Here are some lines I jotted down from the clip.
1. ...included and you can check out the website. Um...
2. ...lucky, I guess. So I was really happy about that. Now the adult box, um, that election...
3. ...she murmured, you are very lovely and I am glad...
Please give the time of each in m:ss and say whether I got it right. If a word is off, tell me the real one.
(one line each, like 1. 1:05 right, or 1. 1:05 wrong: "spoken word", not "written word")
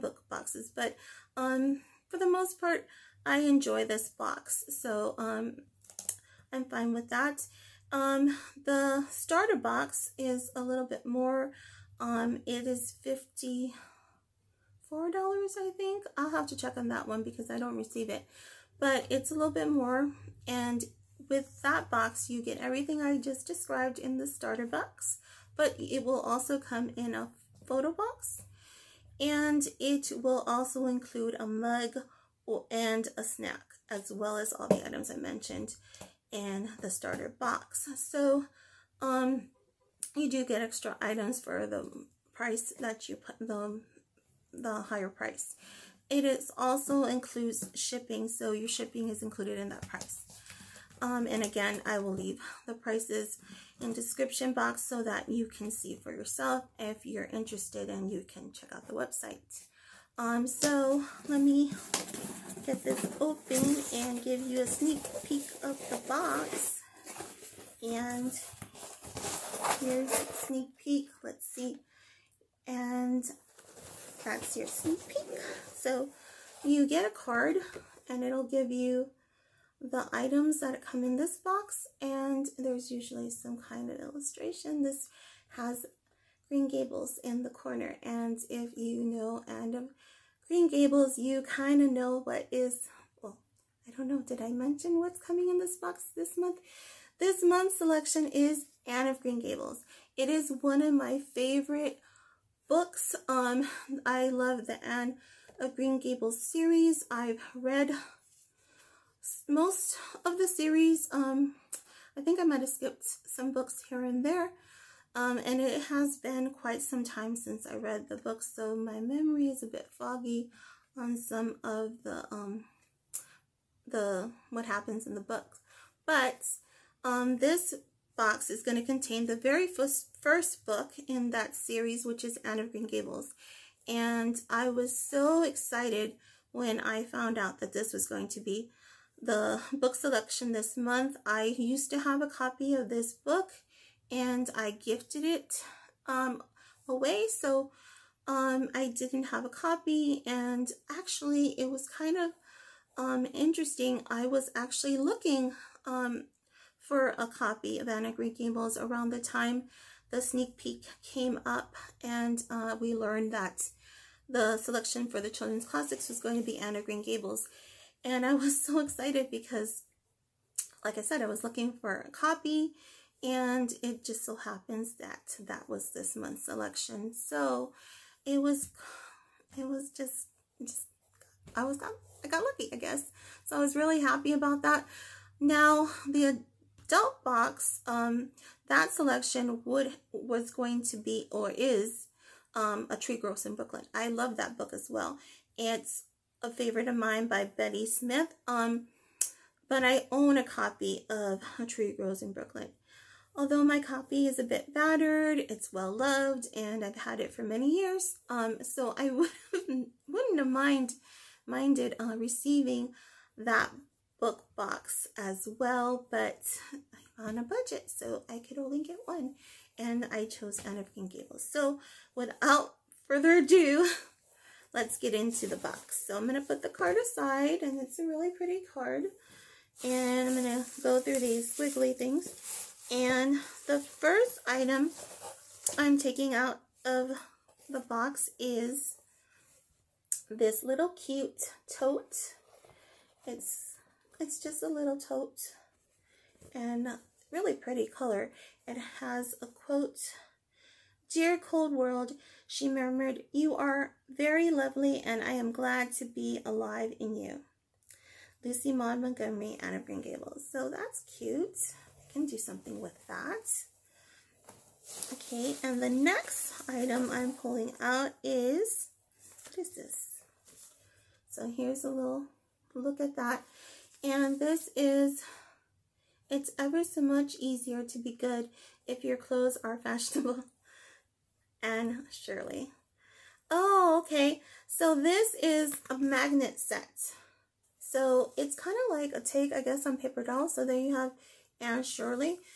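1. 0:57 wrong: "interested", not "included"
2. 3:02 wrong: "selection", not "election"
3. 4:12 right.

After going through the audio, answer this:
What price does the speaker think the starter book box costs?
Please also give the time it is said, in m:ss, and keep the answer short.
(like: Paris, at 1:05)
$54, at 0:13.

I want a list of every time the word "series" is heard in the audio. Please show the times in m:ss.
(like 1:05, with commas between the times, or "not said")
1:46, 1:50, 2:11.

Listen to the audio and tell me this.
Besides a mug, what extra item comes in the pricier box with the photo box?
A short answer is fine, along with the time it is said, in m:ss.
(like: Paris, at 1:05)
a snack, at 0:33.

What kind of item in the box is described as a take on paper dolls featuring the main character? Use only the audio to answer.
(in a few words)
magnet set.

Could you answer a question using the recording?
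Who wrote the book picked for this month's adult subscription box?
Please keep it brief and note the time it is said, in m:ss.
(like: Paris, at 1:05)
Betty Smith, at 3:17.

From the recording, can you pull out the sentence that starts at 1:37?
This month's selection is Anne of Green Gables.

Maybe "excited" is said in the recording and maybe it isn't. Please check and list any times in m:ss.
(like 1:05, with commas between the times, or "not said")
2:15, 2:48.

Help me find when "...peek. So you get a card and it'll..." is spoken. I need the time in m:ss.
1:15.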